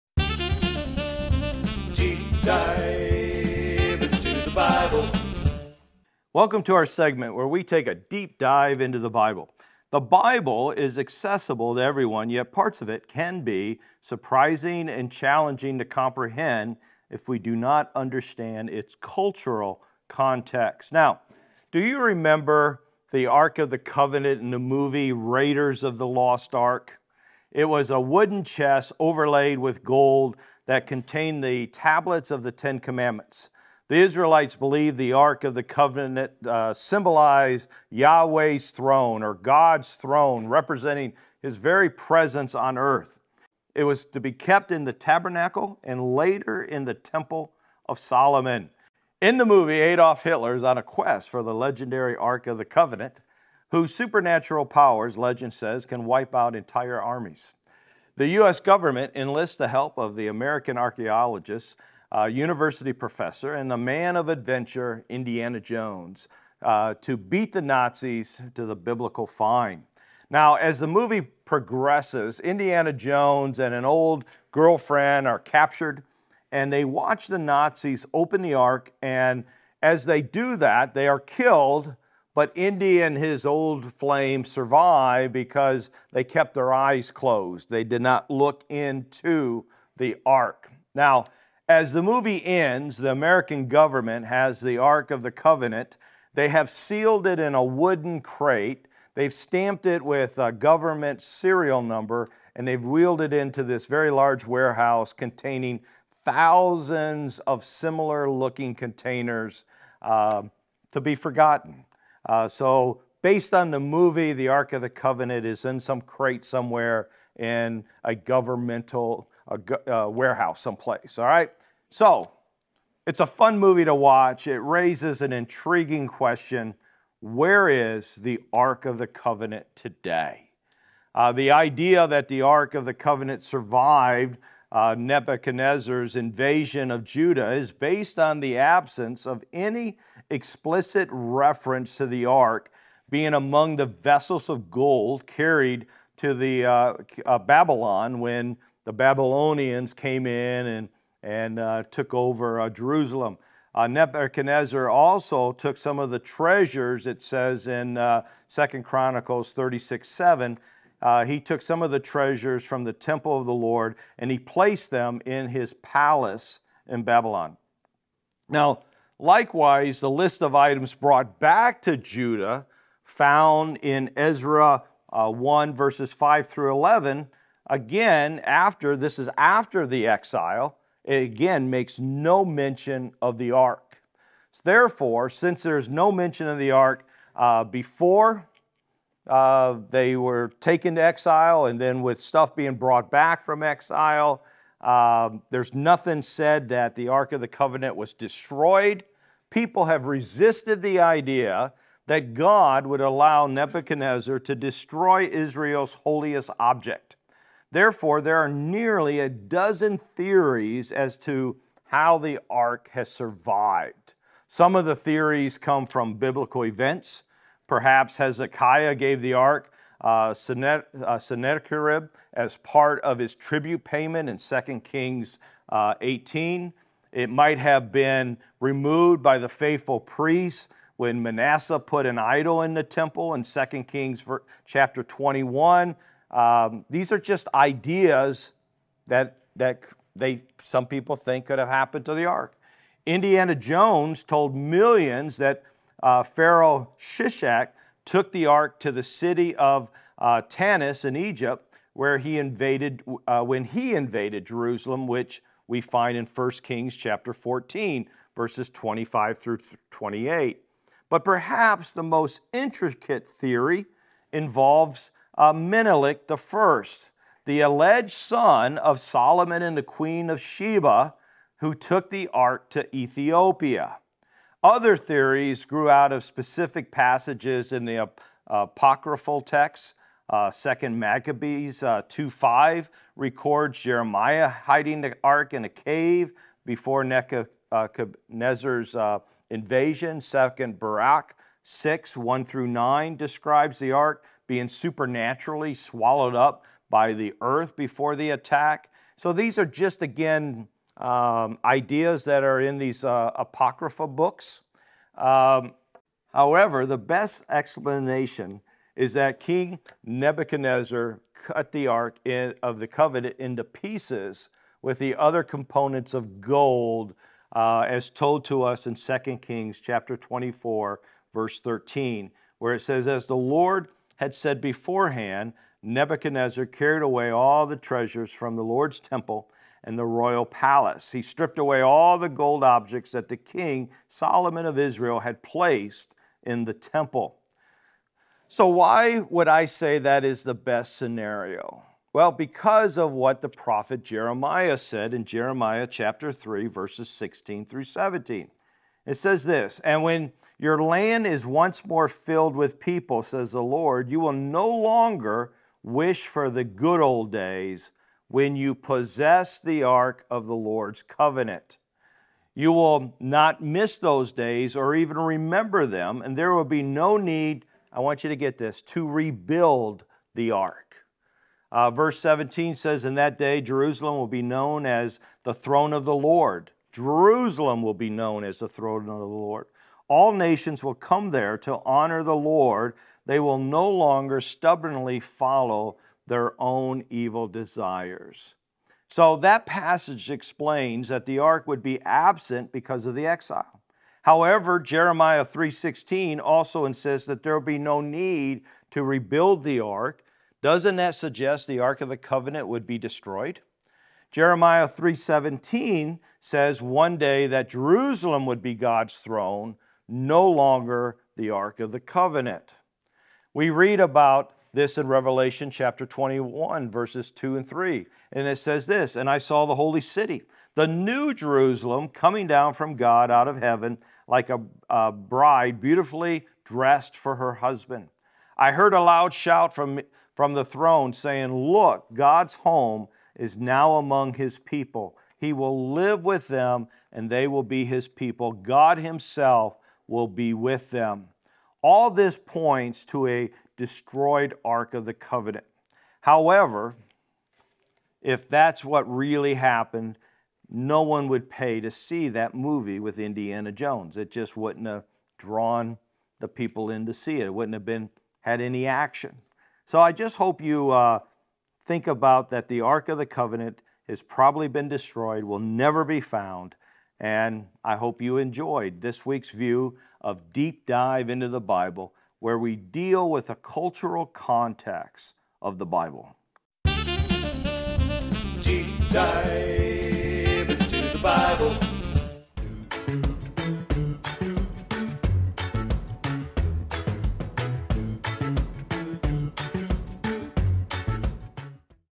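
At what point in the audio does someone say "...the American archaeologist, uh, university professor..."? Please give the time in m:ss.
1:00.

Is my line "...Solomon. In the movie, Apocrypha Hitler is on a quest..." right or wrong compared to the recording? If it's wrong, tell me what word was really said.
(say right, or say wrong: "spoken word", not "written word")
wrong: "Adolf", not "Apocrypha".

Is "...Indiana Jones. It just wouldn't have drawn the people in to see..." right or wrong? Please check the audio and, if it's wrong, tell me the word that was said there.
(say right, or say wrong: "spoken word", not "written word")
right.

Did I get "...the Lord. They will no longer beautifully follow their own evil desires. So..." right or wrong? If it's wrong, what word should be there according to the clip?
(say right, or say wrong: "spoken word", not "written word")
wrong: "stubbornly", not "beautifully".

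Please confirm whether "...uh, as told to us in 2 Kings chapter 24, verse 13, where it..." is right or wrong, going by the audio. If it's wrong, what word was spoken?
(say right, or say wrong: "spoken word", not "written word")
right.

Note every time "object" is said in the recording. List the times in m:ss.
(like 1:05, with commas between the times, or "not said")
3:26, 5:32.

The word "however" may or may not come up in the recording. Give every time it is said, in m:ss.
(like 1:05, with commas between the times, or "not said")
5:06, 6:34, 7:26.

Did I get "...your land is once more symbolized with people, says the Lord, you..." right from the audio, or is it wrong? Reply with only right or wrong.
wrong.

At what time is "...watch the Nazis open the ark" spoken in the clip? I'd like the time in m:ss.
1:16.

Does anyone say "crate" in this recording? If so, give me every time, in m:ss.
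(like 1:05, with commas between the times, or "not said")
1:38, 1:56.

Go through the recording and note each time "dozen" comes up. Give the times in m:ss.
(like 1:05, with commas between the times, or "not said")
3:29.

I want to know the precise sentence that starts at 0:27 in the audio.
It was a wooden chest overlaid with gold that contained the tablets of the Ten Commandments.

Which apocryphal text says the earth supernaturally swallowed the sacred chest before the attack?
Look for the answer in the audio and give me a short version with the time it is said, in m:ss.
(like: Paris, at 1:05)
Second Baruch, at 4:50.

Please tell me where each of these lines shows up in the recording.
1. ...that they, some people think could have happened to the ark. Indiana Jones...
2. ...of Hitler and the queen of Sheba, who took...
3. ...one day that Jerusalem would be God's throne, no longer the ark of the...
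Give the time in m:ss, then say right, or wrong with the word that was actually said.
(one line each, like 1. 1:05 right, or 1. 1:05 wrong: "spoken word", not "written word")
1. 3:59 right
2. 4:28 wrong: "Solomon", not "Hitler"
3. 6:46 right.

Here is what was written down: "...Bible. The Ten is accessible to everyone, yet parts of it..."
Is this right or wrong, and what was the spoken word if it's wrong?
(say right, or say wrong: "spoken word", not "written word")
wrong: "Bible", not "Ten".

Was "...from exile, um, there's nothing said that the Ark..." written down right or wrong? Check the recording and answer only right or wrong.
right.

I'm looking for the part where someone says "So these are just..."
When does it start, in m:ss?
4:59.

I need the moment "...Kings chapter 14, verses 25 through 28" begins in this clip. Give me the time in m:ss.
4:16.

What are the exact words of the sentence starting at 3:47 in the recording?
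It might have been removed by the faithful priests when Manasseh put an idol in the temple in 2 Kings chapter 21.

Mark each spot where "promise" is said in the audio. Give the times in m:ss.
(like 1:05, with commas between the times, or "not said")
not said.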